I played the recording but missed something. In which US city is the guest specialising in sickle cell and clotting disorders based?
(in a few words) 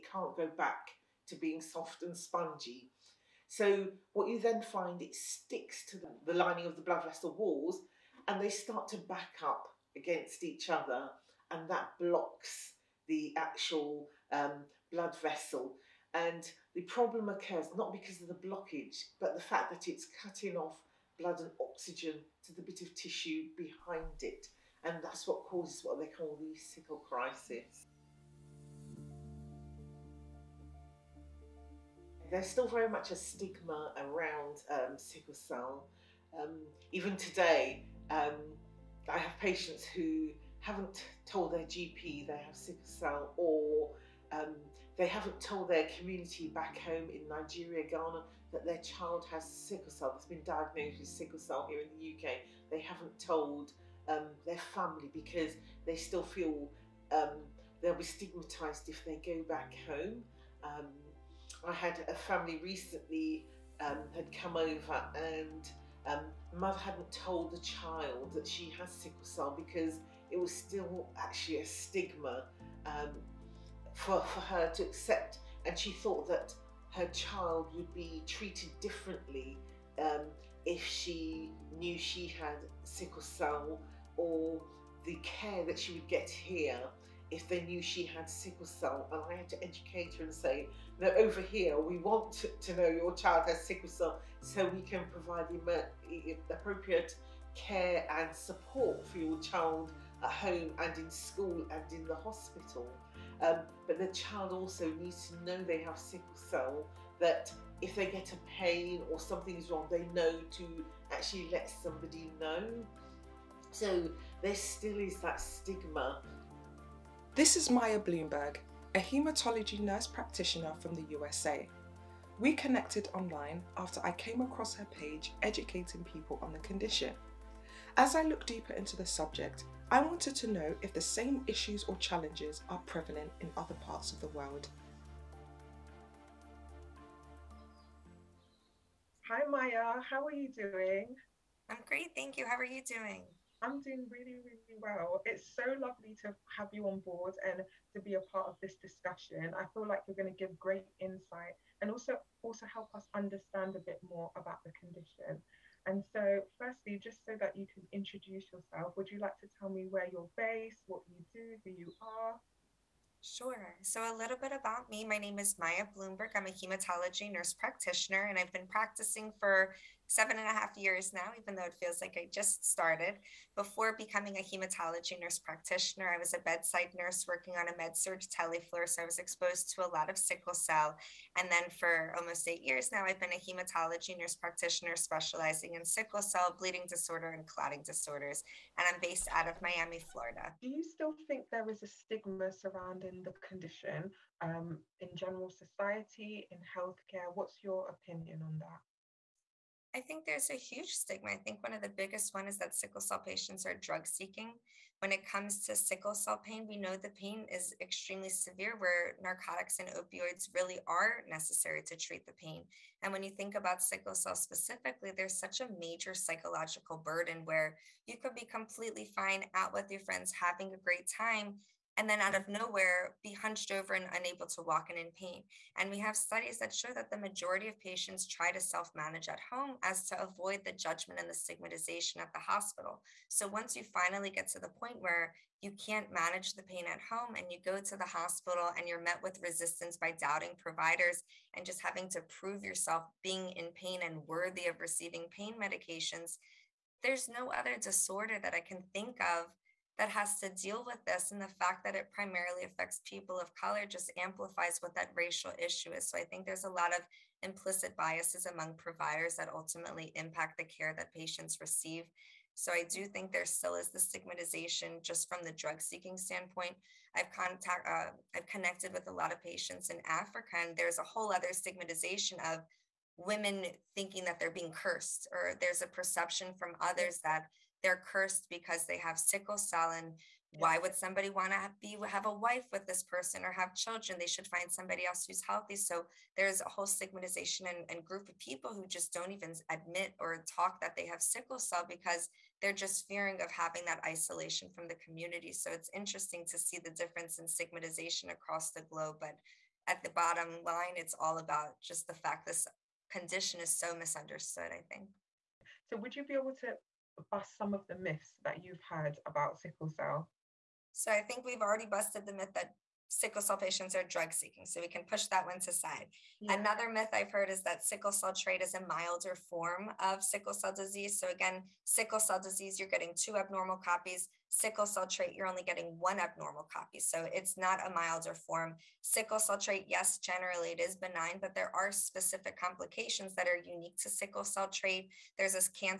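Miami.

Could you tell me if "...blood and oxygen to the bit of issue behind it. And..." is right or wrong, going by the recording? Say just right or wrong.
wrong.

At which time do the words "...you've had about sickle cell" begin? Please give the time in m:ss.
5:08.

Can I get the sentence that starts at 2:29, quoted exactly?
I feel like you're going to give great insight and also also help us understand a bit more about the condition.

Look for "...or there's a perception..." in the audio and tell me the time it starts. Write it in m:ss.
4:35.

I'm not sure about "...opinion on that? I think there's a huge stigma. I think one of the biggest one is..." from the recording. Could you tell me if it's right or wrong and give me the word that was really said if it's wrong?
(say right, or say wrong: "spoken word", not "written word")
right.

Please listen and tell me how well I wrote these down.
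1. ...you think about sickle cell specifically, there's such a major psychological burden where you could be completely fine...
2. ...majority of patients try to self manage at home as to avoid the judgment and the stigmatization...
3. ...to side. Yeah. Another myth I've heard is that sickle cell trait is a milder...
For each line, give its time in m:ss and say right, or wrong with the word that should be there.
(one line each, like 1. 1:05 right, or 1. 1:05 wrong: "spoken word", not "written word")
1. 3:33 right
2. 3:47 right
3. 5:15 right.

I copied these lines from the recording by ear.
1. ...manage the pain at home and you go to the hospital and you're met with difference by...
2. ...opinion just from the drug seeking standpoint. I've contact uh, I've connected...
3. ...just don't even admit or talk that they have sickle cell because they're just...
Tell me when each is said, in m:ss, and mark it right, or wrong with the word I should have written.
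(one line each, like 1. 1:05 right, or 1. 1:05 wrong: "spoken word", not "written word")
1. 3:56 wrong: "resistance", not "difference"
2. 4:23 wrong: "stigmatization", not "opinion"
3. 4:48 right.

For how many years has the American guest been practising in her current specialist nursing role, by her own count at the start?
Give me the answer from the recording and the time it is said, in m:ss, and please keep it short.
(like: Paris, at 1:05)
7.5 years, at 2:50.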